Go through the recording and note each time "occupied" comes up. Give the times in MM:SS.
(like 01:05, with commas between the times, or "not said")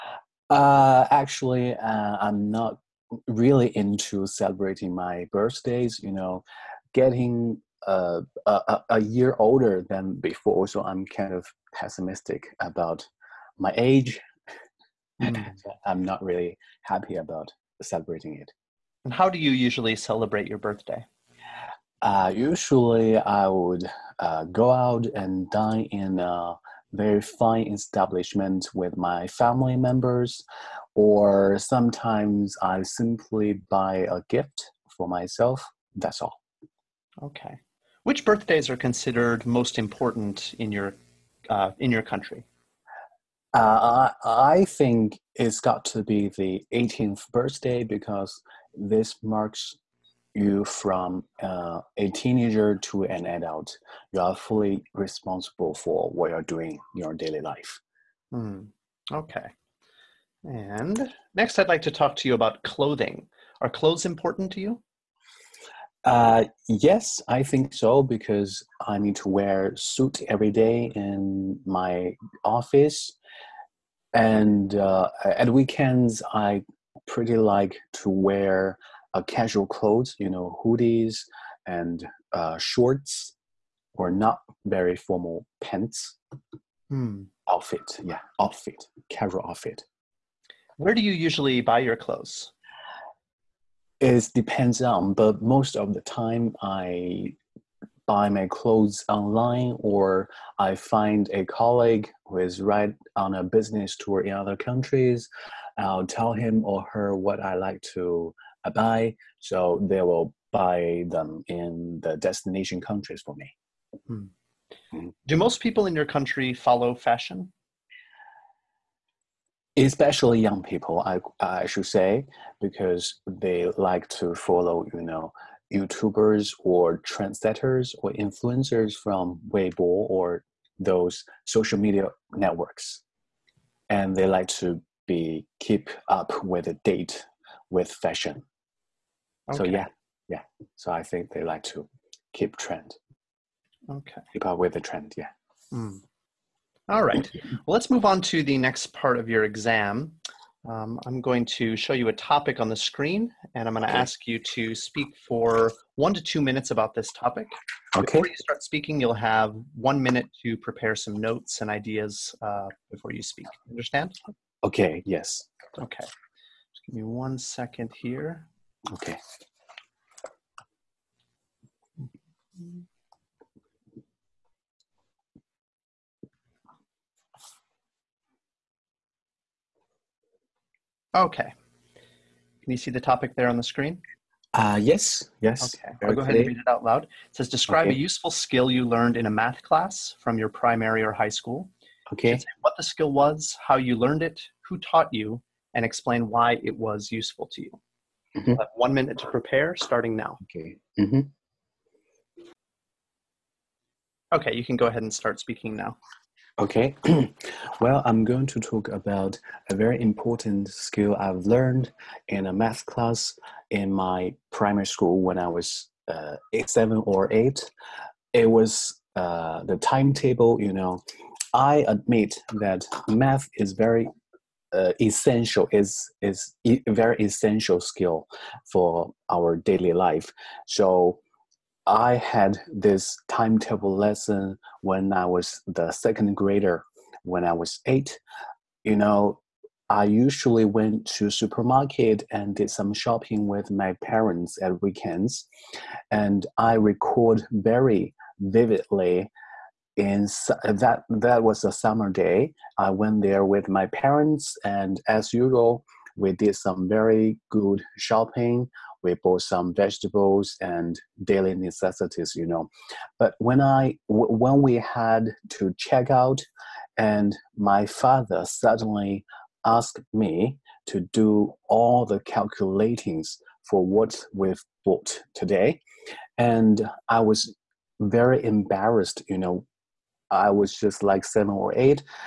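not said.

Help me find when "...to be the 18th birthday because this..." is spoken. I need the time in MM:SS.
00:45.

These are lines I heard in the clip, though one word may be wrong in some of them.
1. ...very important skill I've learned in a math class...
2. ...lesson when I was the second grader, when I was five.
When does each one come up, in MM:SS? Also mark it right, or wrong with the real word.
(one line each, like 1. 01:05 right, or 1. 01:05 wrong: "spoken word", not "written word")
1. 03:29 right
2. 03:53 wrong: "eight", not "five".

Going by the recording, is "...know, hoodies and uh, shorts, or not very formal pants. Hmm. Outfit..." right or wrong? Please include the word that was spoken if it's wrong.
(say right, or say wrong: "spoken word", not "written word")
right.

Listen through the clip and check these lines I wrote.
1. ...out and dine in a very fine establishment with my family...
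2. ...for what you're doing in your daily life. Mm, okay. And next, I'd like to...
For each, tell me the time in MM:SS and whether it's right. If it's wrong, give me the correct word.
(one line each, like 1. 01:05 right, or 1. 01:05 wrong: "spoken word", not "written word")
1. 00:24 right
2. 00:55 right.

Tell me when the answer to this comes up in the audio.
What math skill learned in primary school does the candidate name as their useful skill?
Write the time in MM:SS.
03:39.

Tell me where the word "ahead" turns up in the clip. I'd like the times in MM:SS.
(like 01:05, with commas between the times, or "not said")
03:06, 03:24.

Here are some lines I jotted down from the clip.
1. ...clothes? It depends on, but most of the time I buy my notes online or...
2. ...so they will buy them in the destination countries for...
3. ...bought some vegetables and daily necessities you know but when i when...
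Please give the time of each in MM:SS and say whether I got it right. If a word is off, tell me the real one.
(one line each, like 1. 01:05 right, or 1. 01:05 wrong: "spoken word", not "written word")
1. 01:31 wrong: "clothes", not "notes"
2. 01:49 right
3. 04:19 right.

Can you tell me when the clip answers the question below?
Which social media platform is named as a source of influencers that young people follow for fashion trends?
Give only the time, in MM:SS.
02:09.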